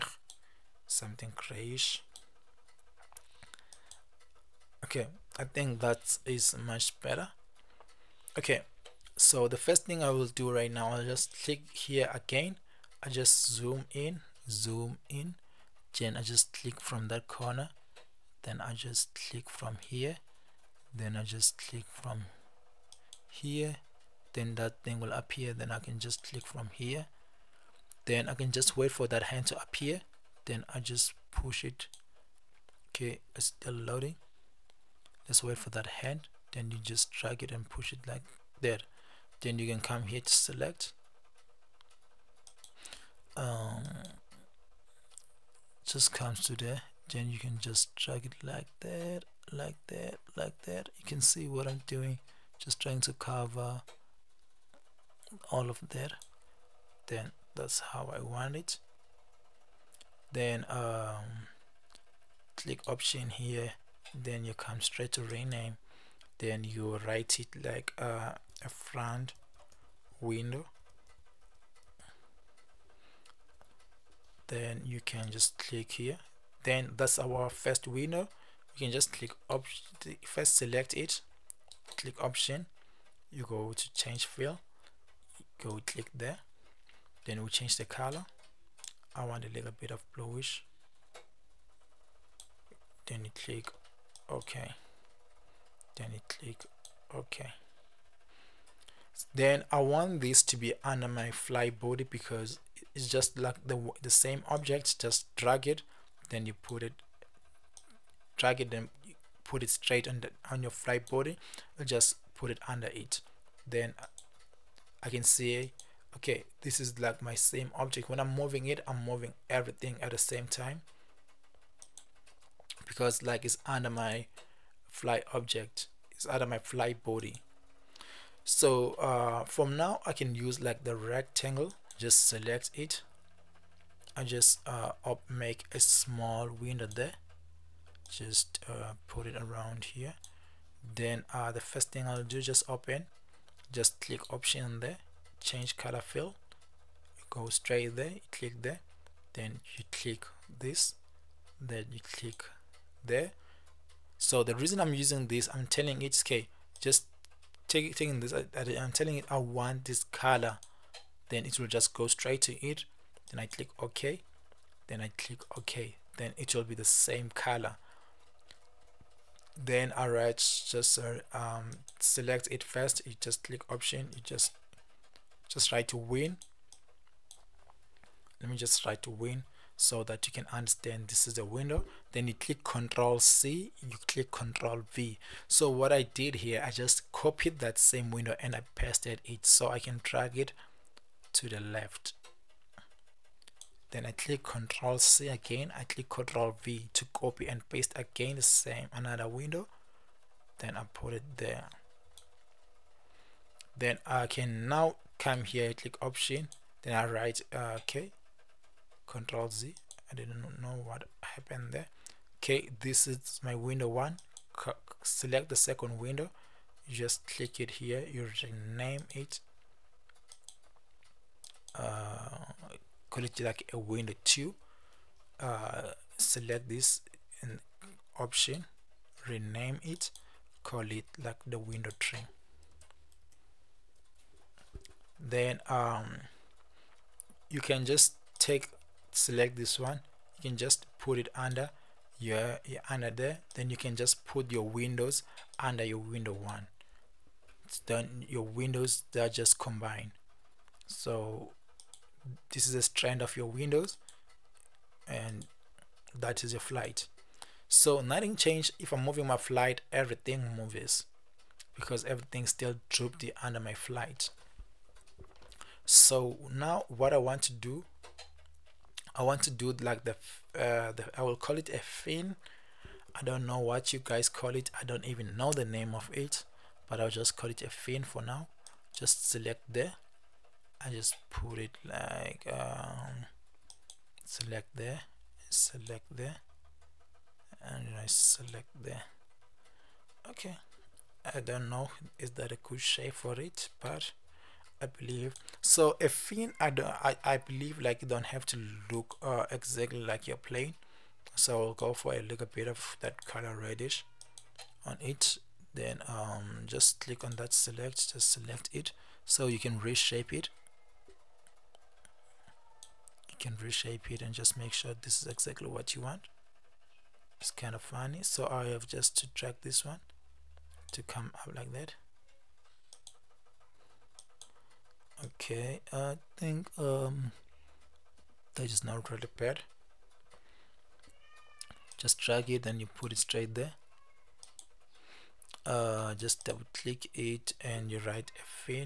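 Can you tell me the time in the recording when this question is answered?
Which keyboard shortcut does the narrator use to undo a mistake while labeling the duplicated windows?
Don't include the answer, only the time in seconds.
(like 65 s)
209 s.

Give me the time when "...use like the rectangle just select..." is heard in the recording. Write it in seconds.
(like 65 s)
130 s.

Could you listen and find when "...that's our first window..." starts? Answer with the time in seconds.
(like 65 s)
76 s.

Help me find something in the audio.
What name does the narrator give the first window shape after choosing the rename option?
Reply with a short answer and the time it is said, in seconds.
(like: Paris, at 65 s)
front window, at 68 s.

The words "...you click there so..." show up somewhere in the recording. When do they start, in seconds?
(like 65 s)
151 s.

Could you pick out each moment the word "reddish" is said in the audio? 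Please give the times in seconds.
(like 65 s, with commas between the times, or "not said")
303 s.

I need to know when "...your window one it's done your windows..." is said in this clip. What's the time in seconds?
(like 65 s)
245 s.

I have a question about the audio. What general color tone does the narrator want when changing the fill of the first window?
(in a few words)
bluish.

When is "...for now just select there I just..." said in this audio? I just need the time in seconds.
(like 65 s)
278 s.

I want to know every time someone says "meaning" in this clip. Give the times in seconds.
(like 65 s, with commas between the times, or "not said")
not said.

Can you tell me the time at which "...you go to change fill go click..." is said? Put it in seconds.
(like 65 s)
83 s.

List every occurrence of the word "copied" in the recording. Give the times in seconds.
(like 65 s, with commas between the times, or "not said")
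187 s.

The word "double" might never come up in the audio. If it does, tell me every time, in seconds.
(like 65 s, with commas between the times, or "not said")
336 s.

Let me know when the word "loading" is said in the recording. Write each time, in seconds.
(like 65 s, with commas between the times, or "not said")
33 s.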